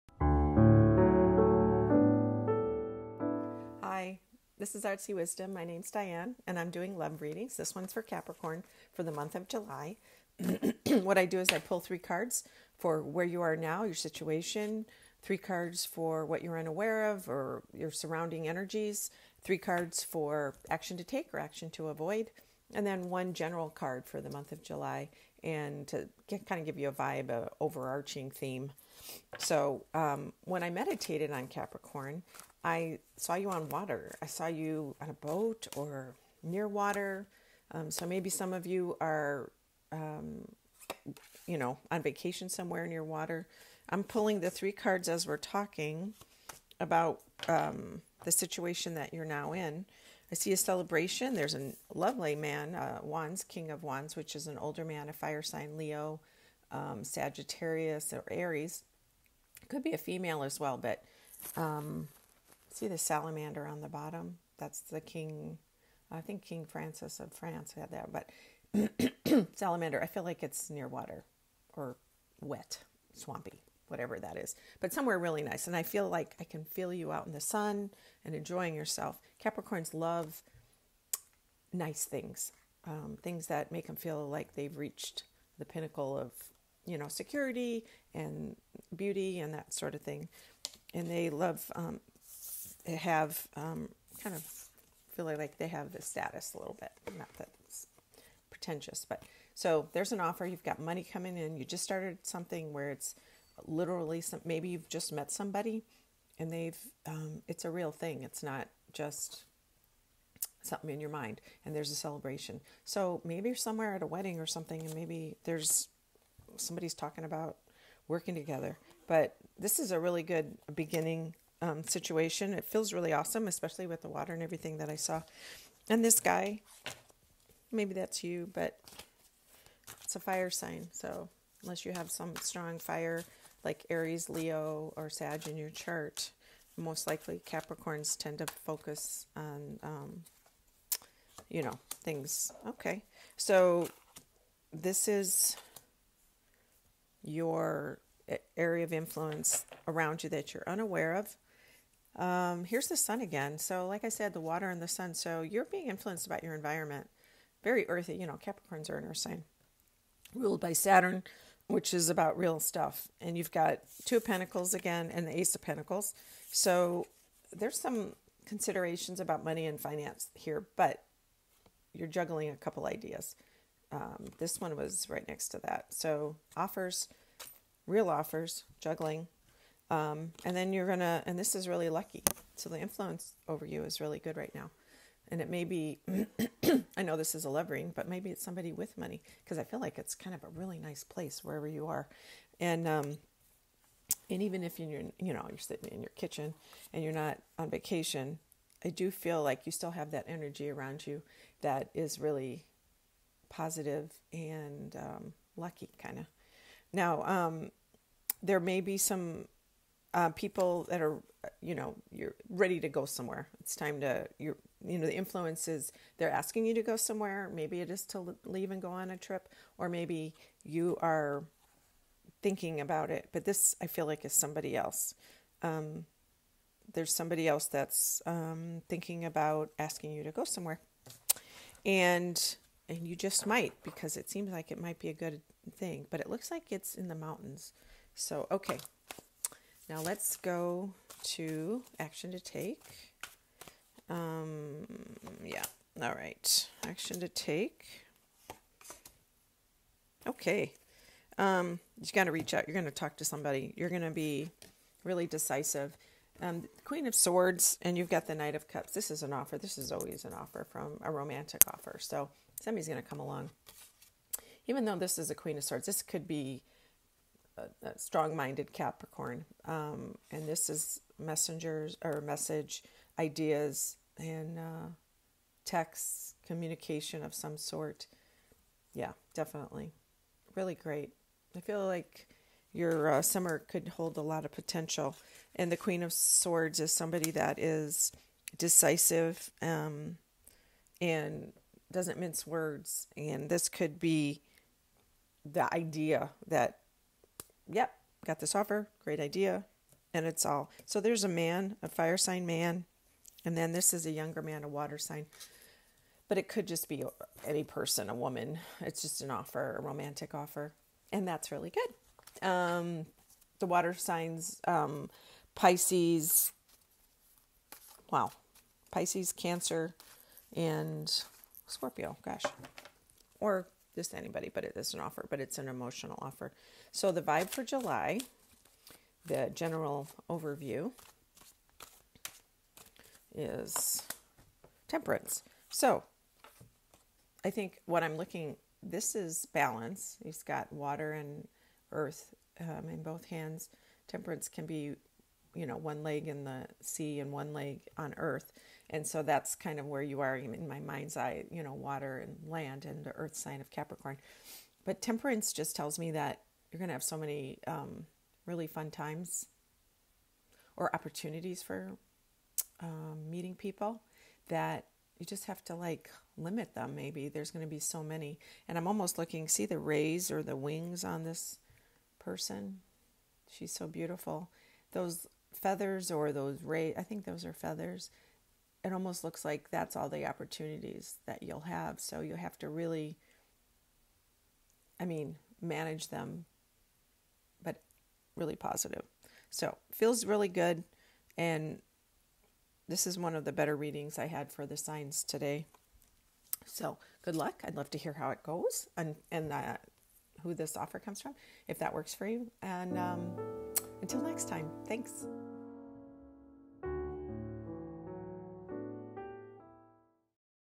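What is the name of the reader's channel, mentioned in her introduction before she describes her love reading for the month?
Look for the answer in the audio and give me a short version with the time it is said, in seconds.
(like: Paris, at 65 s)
Artsy Wisdom, at 4 s.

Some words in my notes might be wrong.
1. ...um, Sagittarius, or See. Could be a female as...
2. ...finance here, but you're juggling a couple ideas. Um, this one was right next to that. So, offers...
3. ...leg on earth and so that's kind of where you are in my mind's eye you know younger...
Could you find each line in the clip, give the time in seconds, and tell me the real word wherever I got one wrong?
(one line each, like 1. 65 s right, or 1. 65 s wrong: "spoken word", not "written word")
1. 56 s wrong: "Aries", not "See"
2. 169 s right
3. 347 s wrong: "water", not "younger".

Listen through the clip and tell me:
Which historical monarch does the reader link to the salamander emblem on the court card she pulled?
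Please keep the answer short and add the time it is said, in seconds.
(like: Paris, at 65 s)
King Francis of France, at 66 s.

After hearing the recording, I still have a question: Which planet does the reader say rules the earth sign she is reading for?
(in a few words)
Saturn.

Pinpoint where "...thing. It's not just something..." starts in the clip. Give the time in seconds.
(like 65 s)
107 s.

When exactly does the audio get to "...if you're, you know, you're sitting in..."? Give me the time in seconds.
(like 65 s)
194 s.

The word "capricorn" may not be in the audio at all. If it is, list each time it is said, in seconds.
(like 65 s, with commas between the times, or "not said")
8 s, 31 s, 79 s, 137 s, 158 s, 268 s, 353 s.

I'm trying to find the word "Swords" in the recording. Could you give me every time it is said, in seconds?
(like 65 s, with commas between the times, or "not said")
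257 s, 265 s, 286 s.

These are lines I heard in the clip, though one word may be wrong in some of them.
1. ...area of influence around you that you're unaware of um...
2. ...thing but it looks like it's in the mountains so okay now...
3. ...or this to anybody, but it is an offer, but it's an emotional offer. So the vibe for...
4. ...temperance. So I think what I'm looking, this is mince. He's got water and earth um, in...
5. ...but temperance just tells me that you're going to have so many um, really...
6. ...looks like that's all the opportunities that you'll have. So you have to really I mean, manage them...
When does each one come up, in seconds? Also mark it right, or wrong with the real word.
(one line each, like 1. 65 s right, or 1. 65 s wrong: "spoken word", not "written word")
1. 148 s right
2. 235 s right
3. 323 s right
4. 334 s wrong: "balance", not "mince"
5. 354 s right
6. 379 s right.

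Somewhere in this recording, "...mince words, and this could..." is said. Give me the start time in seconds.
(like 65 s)
292 s.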